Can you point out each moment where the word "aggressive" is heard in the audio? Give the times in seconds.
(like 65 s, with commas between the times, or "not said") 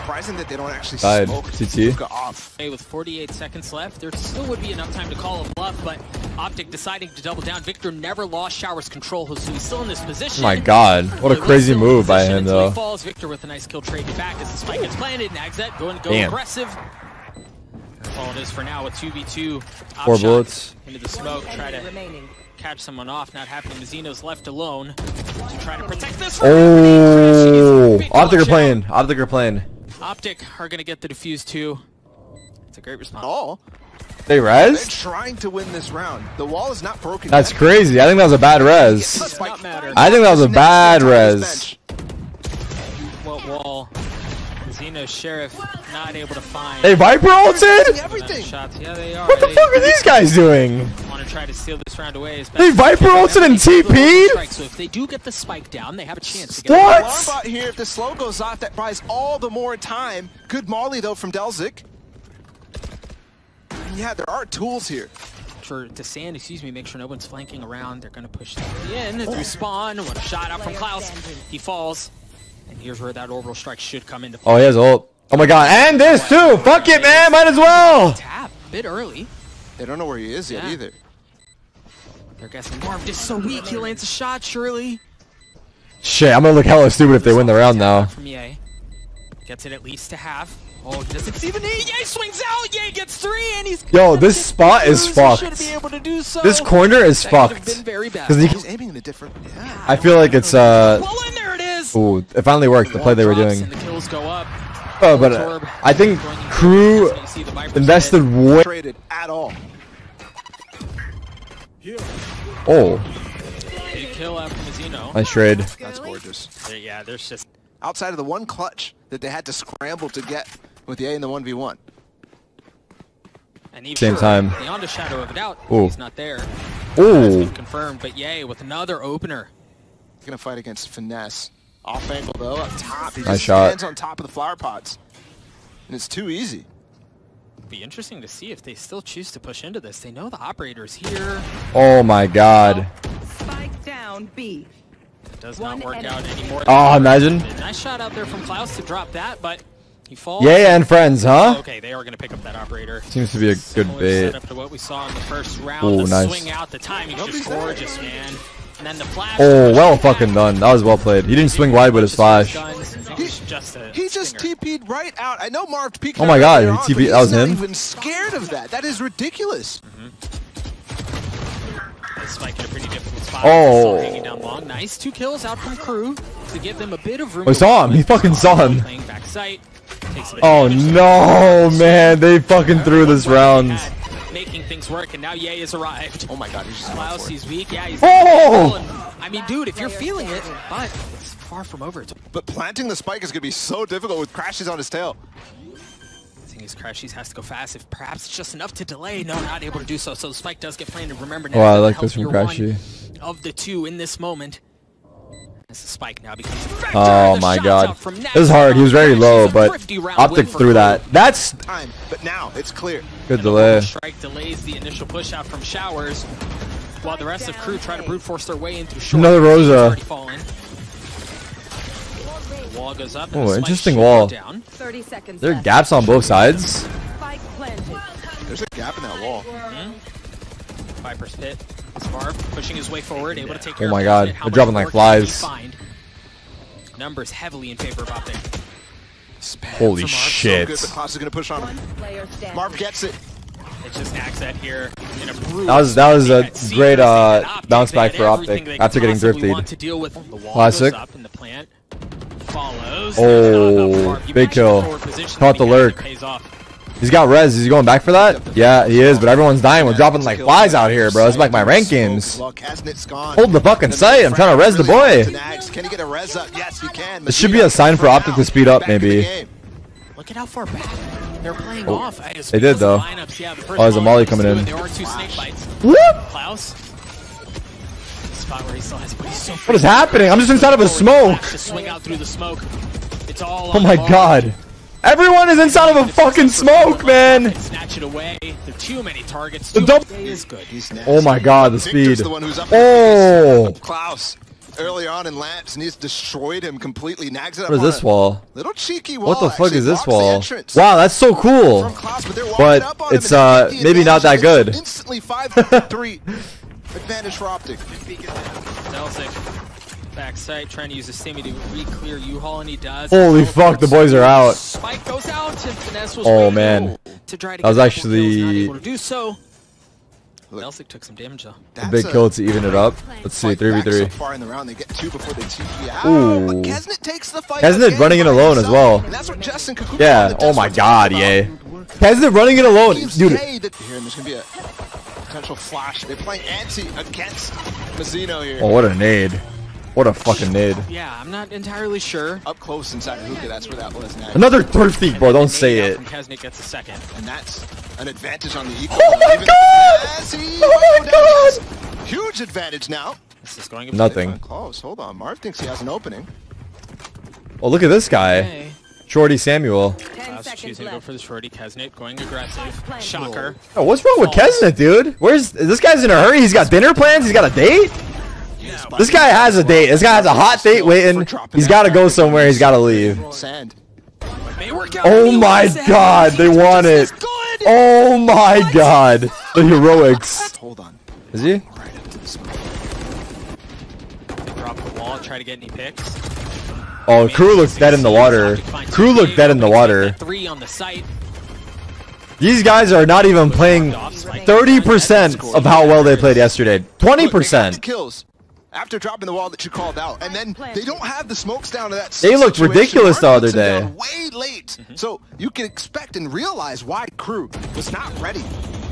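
16 s, 362 s.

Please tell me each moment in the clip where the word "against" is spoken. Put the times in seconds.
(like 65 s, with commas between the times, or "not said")
130 s, 336 s.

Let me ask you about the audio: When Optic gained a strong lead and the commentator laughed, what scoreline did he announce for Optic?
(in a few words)
5-3.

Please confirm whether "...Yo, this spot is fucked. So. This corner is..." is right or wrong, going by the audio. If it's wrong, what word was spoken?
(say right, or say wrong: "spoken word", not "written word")
right.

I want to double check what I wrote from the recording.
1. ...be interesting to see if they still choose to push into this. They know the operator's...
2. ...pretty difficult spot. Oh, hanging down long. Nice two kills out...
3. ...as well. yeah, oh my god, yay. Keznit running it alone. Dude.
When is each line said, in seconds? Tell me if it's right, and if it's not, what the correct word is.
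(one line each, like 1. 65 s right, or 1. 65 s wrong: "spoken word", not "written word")
1. 137 s right
2. 172 s right
3. 328 s right.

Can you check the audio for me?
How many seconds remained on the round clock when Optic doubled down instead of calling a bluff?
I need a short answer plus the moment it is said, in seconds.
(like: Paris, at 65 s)
48, at 2 s.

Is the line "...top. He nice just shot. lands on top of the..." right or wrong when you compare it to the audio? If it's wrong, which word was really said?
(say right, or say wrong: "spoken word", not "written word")
wrong: "stands", not "lands".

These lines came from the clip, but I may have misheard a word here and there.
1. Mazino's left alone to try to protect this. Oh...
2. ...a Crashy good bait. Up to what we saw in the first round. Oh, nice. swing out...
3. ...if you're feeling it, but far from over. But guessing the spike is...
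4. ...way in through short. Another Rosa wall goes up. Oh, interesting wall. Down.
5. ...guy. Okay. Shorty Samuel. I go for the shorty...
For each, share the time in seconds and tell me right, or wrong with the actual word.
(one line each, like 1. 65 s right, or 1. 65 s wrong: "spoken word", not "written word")
1. 23 s right
2. 153 s wrong: "Similar", not "Crashy"
3. 189 s wrong: "planting", not "guessing"
4. 218 s right
5. 358 s right.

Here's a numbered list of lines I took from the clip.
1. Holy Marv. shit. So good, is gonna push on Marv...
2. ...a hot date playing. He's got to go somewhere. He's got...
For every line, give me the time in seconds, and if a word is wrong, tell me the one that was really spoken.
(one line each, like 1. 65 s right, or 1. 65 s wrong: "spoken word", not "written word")
1. 239 s right
2. 370 s wrong: "waiting", not "playing".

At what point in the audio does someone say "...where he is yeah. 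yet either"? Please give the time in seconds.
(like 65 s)
80 s.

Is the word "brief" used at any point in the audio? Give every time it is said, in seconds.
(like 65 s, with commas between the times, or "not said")
not said.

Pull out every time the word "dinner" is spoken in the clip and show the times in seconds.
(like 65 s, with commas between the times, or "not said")
366 s.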